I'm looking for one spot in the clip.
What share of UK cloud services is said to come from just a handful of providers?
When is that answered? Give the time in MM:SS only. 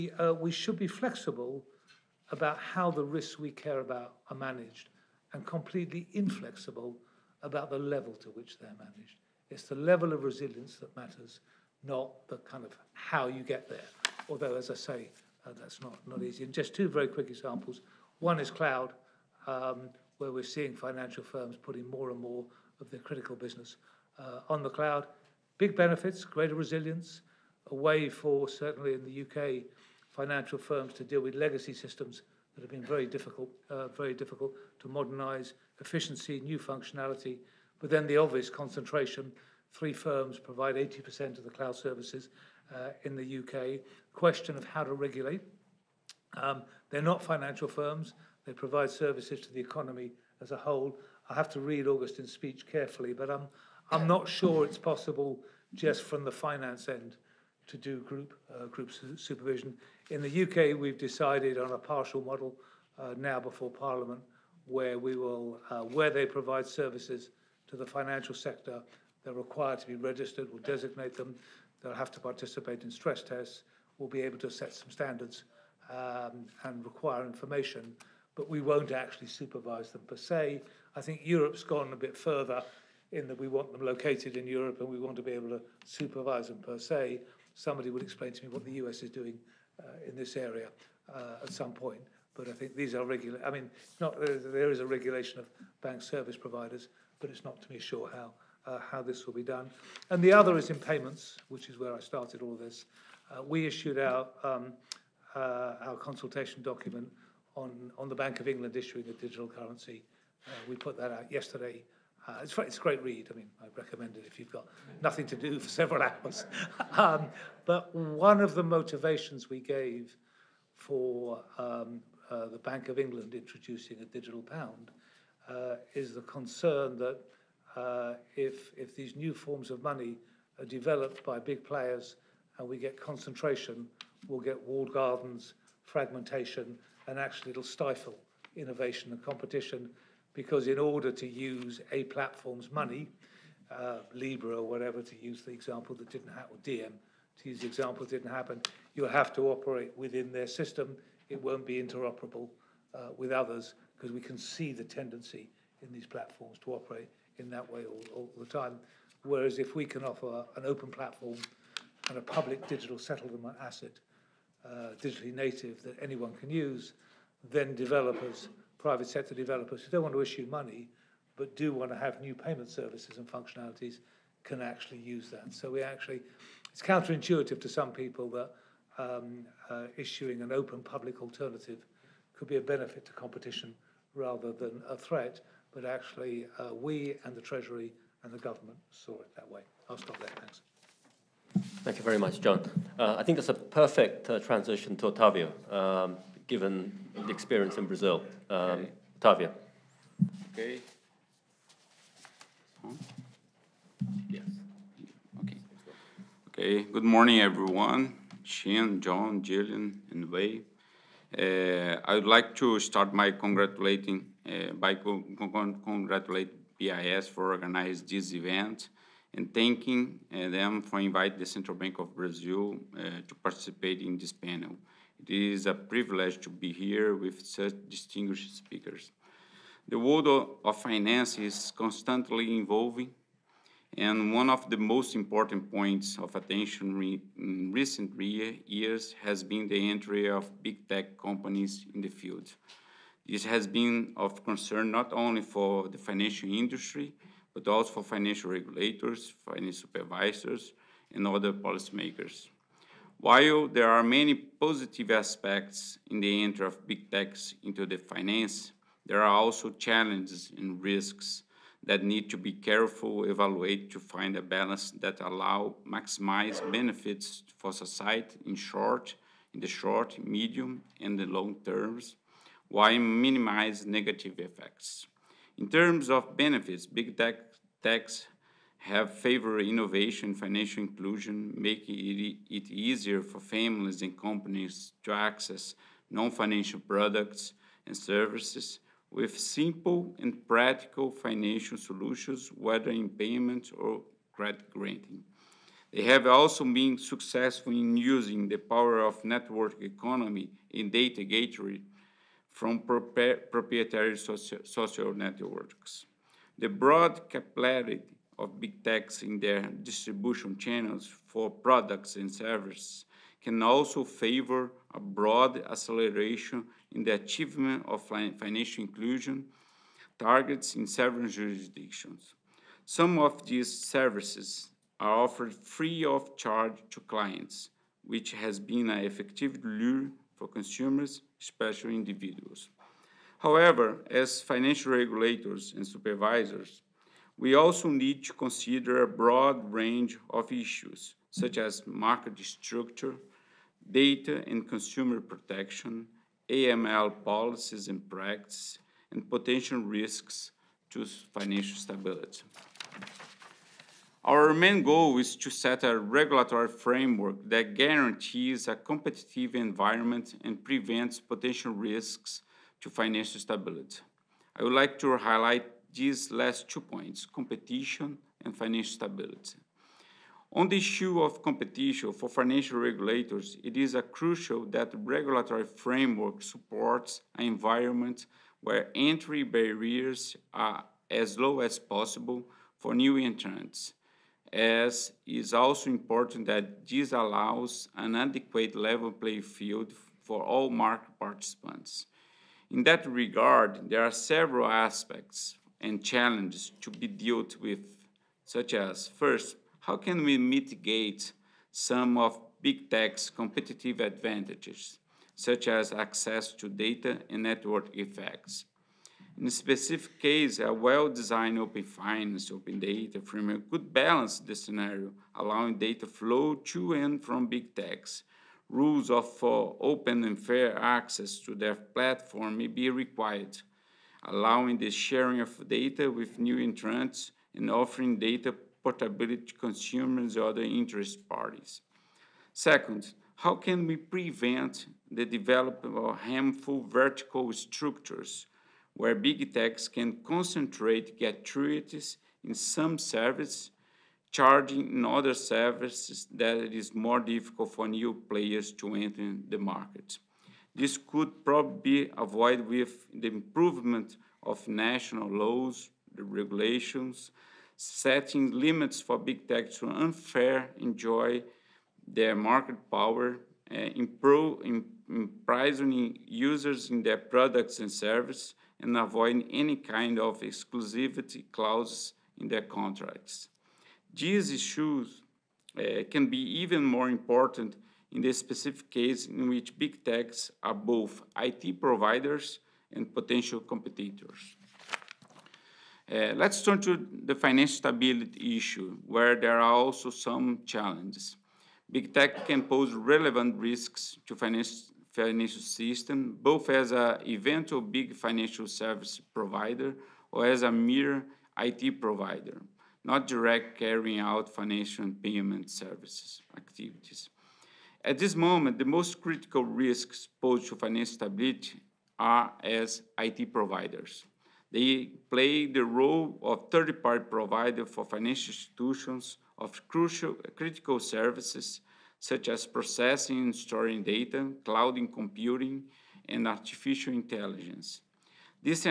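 00:40.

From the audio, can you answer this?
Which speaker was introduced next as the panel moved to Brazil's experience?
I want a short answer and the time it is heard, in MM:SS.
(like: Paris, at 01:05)
Otavio, at 03:15.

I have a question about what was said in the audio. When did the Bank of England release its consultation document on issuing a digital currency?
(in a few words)
Yesterday.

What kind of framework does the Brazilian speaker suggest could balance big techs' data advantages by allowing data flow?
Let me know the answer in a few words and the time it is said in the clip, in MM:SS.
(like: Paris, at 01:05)
Open finance, open data, at 06:51.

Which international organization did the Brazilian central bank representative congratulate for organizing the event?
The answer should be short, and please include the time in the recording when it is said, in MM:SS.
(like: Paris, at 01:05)
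BIS, at 03:36.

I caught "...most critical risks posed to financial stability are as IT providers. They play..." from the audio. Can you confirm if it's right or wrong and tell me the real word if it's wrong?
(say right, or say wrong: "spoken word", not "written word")
right.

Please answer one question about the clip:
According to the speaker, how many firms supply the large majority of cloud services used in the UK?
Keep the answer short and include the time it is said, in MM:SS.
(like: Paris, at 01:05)
3, at 00:39.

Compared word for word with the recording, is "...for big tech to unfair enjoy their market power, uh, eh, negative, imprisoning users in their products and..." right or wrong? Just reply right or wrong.
wrong.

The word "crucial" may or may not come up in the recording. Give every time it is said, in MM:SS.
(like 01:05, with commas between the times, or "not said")
06:14, 08:39.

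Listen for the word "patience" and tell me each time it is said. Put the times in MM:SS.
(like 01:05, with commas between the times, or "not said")
not said.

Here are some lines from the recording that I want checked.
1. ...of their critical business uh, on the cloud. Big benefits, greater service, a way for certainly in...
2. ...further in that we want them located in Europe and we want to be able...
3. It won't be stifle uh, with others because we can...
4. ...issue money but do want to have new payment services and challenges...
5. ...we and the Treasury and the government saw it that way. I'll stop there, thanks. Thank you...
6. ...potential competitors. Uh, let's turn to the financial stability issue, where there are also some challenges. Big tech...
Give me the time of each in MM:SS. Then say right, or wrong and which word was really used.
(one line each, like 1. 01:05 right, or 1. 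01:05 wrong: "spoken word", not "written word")
1. 00:22 wrong: "resilience", not "service"
2. 01:22 right
3. 02:31 wrong: "interoperable", not "stifle"
4. 02:50 wrong: "functionalities", not "challenges"
5. 03:06 right
6. 08:03 right.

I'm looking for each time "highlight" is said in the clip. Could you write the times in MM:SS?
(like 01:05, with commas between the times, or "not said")
06:05.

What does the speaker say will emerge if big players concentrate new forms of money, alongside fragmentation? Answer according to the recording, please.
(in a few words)
Walled gardens.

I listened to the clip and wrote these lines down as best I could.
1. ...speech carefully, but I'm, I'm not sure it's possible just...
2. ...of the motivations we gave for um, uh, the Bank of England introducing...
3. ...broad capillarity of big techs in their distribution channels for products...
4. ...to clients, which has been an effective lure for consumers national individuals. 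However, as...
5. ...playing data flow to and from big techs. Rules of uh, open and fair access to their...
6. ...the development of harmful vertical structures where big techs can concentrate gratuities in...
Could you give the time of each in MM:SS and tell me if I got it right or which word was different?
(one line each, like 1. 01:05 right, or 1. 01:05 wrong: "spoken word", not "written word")
1. 00:52 right
2. 01:58 right
3. 05:06 right
4. 05:26 wrong: "special", not "national"
5. 06:55 wrong: "allowing", not "playing"
6. 07:15 right.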